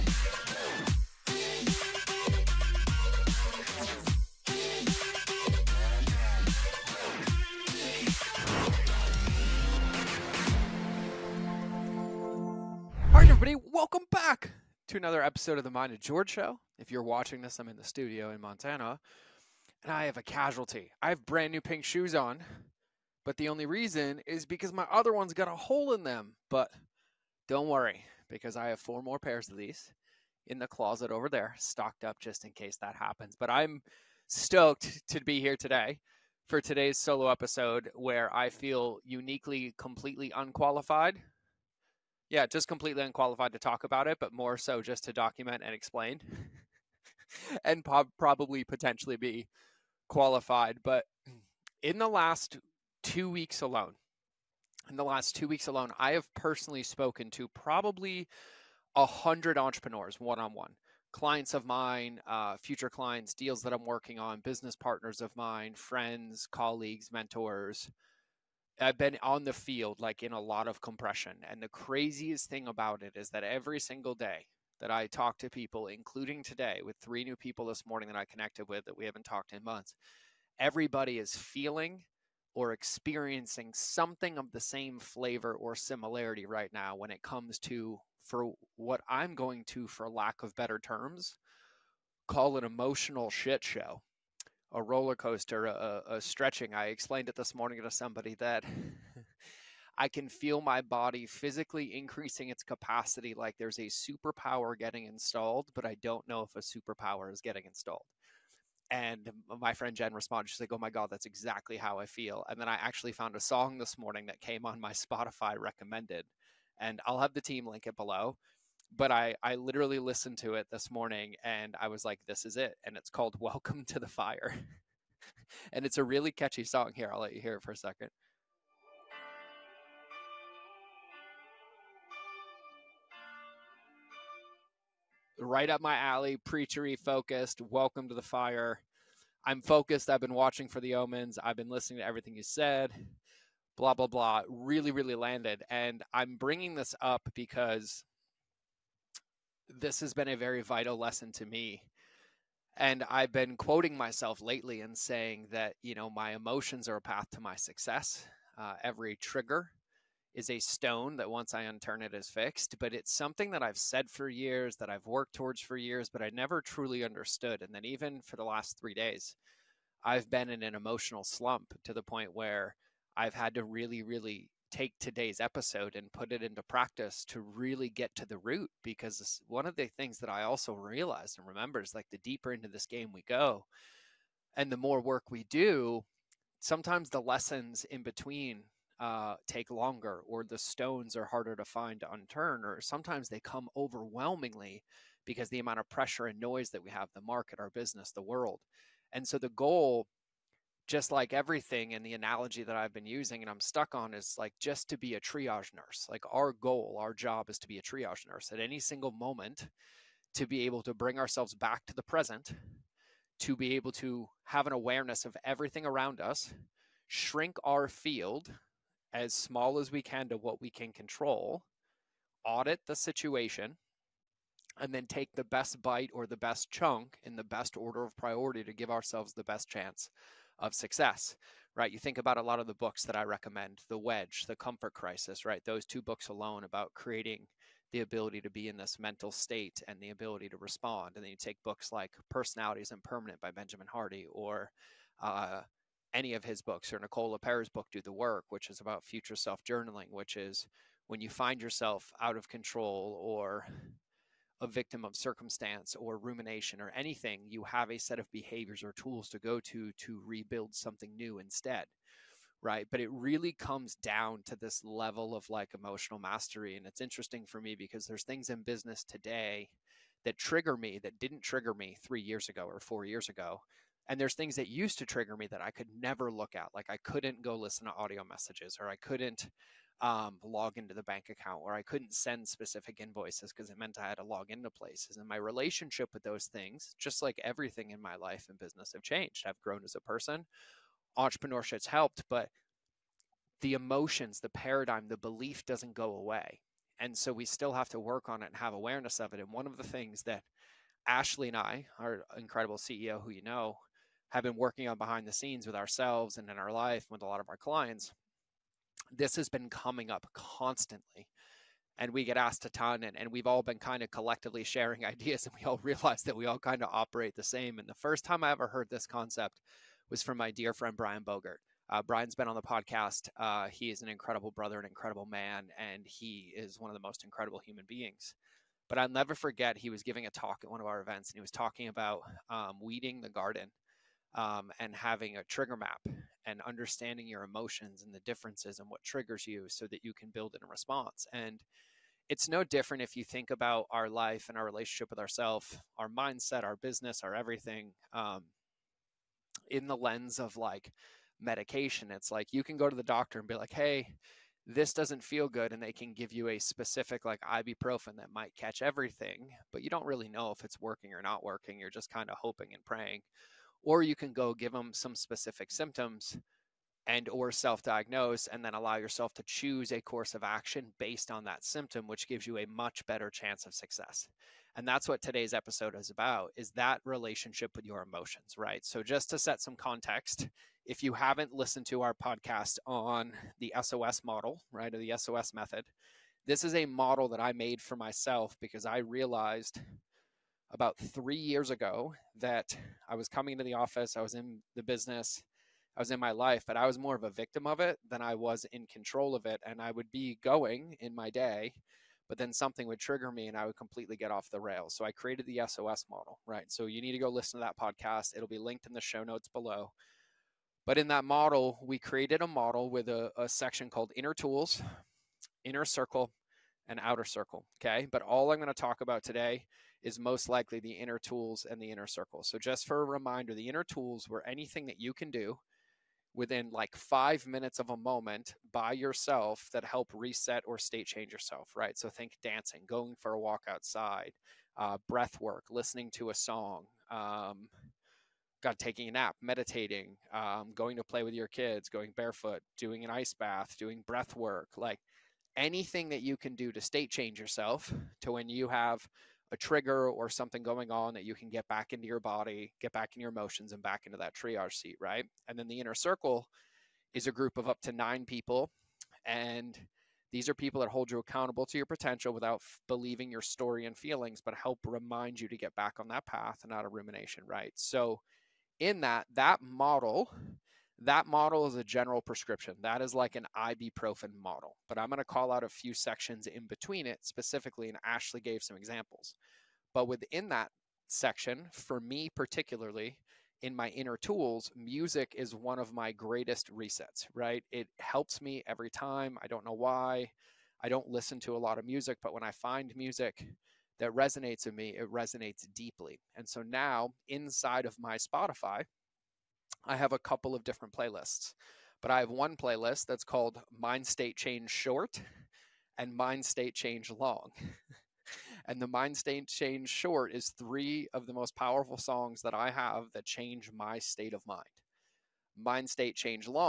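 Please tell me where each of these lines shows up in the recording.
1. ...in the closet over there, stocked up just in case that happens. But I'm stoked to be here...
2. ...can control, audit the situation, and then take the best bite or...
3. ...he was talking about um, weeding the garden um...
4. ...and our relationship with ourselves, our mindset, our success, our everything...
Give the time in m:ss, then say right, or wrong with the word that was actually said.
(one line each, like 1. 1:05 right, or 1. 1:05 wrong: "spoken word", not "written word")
1. 0:30 right
2. 3:40 right
3. 5:31 right
4. 5:44 wrong: "business", not "success".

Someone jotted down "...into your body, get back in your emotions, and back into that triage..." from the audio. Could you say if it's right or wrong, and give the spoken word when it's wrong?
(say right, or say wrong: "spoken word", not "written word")
right.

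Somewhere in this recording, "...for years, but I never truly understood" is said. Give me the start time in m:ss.
2:45.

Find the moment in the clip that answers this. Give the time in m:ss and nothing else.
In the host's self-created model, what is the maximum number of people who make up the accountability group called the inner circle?
7:37.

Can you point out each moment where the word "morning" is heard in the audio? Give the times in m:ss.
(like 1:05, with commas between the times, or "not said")
1:17, 1:37, 1:53, 2:00.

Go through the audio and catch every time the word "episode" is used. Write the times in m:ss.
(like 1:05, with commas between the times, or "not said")
0:15, 0:37, 2:55, 6:15.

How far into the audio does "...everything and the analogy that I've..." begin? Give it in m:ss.
3:21.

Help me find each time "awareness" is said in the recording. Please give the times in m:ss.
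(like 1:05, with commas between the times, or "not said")
3:34, 4:58.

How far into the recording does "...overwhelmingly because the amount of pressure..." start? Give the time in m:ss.
3:13.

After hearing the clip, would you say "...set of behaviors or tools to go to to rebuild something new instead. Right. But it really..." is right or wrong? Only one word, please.
right.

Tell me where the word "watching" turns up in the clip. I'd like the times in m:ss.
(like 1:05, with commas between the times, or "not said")
0:17, 2:20.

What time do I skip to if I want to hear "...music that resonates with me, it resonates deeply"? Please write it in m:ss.
8:12.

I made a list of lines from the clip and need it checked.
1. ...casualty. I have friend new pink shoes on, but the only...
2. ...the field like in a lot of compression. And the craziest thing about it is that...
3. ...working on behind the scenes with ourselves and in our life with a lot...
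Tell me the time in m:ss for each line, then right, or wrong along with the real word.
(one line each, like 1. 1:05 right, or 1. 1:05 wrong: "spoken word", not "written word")
1. 0:20 wrong: "brand", not "friend"
2. 1:09 right
3. 5:04 right.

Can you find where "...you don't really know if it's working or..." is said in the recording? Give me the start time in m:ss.
5:59.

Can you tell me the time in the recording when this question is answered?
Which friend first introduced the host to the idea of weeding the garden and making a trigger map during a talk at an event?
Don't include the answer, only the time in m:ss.
5:20.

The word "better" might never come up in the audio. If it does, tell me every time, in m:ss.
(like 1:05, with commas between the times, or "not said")
1:30, 6:13.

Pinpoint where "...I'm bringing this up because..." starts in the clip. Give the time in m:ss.
2:26.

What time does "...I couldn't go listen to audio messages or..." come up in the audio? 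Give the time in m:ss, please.
4:36.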